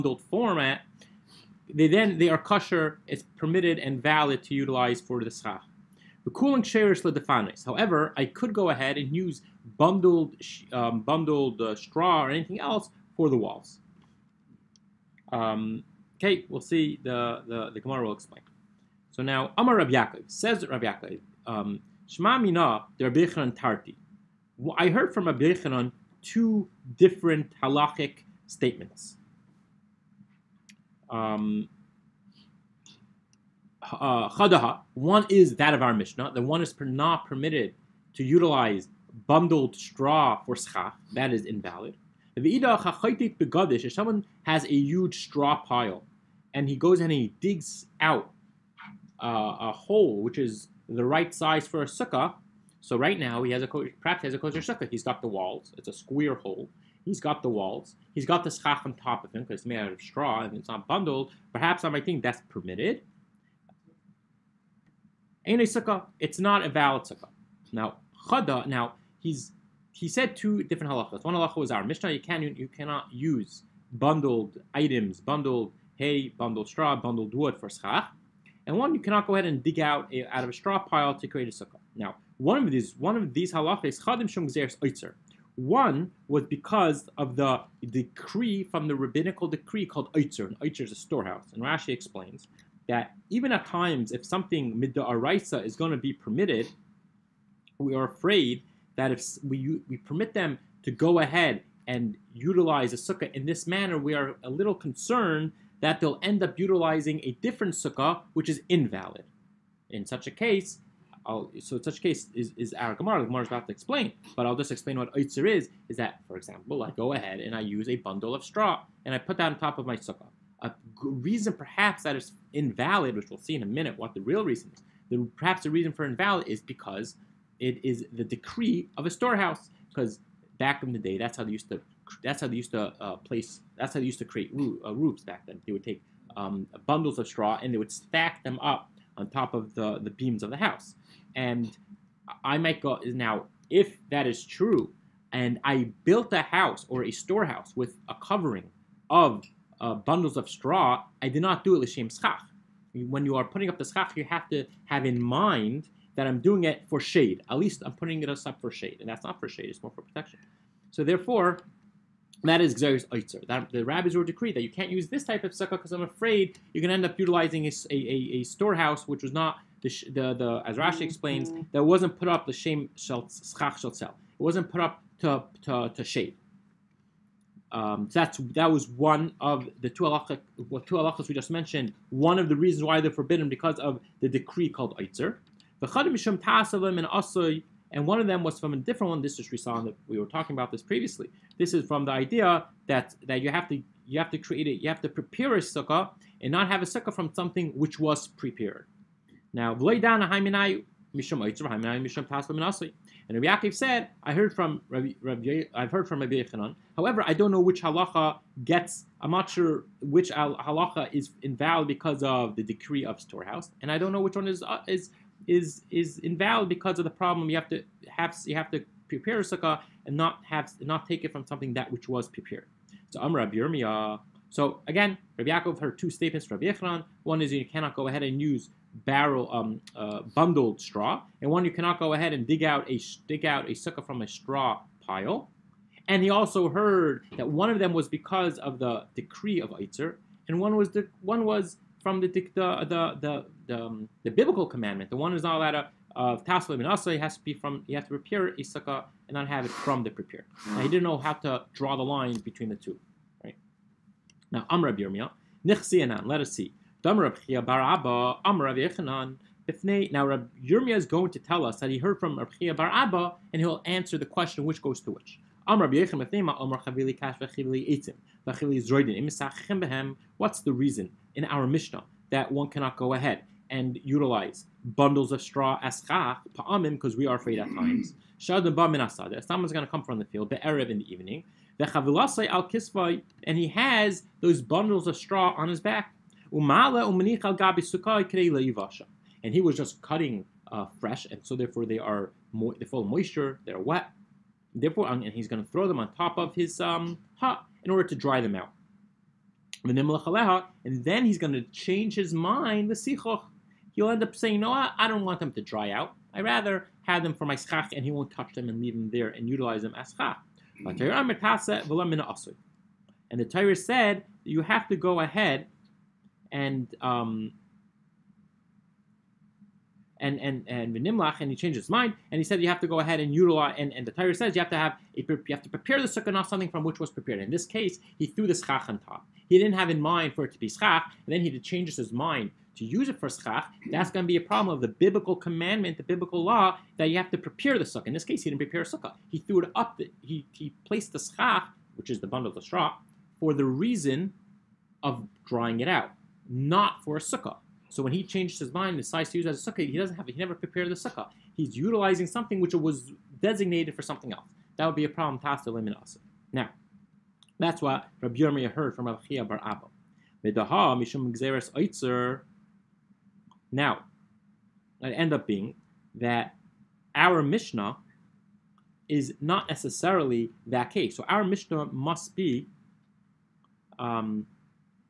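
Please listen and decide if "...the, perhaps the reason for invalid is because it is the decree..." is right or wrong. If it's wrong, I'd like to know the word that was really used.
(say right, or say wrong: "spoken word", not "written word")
right.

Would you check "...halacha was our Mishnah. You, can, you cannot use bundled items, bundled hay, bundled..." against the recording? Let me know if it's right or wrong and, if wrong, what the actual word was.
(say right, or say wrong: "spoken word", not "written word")
right.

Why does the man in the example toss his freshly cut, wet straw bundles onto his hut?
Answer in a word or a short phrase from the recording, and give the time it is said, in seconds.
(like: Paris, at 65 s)
to dry them out, at 298 s.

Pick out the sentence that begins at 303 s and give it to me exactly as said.
He'll end up saying, "No, I don't want them to dry out.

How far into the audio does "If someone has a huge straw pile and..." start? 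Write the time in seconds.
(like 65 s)
42 s.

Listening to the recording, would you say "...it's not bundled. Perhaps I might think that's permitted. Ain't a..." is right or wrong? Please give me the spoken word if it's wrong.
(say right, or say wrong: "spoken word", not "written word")
right.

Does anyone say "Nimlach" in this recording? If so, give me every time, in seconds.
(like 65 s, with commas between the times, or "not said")
320 s.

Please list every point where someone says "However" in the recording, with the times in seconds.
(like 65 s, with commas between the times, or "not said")
7 s, 206 s.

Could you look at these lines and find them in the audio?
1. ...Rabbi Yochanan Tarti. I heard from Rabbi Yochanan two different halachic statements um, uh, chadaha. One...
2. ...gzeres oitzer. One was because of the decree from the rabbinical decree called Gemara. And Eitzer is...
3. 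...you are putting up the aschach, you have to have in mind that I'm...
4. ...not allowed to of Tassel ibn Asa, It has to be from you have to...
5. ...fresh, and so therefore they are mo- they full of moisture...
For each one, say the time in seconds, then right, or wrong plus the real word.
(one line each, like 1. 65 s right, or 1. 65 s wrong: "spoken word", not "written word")
1. 22 s right
2. 84 s wrong: "Eitzer", not "Gemara"
3. 153 s wrong: "schach", not "aschach"
4. 245 s right
5. 290 s right.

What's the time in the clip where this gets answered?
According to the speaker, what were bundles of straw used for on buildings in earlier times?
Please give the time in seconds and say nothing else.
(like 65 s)
134 s.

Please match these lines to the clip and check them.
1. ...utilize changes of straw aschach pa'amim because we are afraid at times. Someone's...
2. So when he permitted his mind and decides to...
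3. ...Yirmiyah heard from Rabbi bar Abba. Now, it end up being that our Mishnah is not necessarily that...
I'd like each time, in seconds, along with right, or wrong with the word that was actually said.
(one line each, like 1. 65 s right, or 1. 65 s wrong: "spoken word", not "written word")
1. 274 s wrong: "bundles", not "changes"
2. 347 s wrong: "changed", not "permitted"
3. 358 s right.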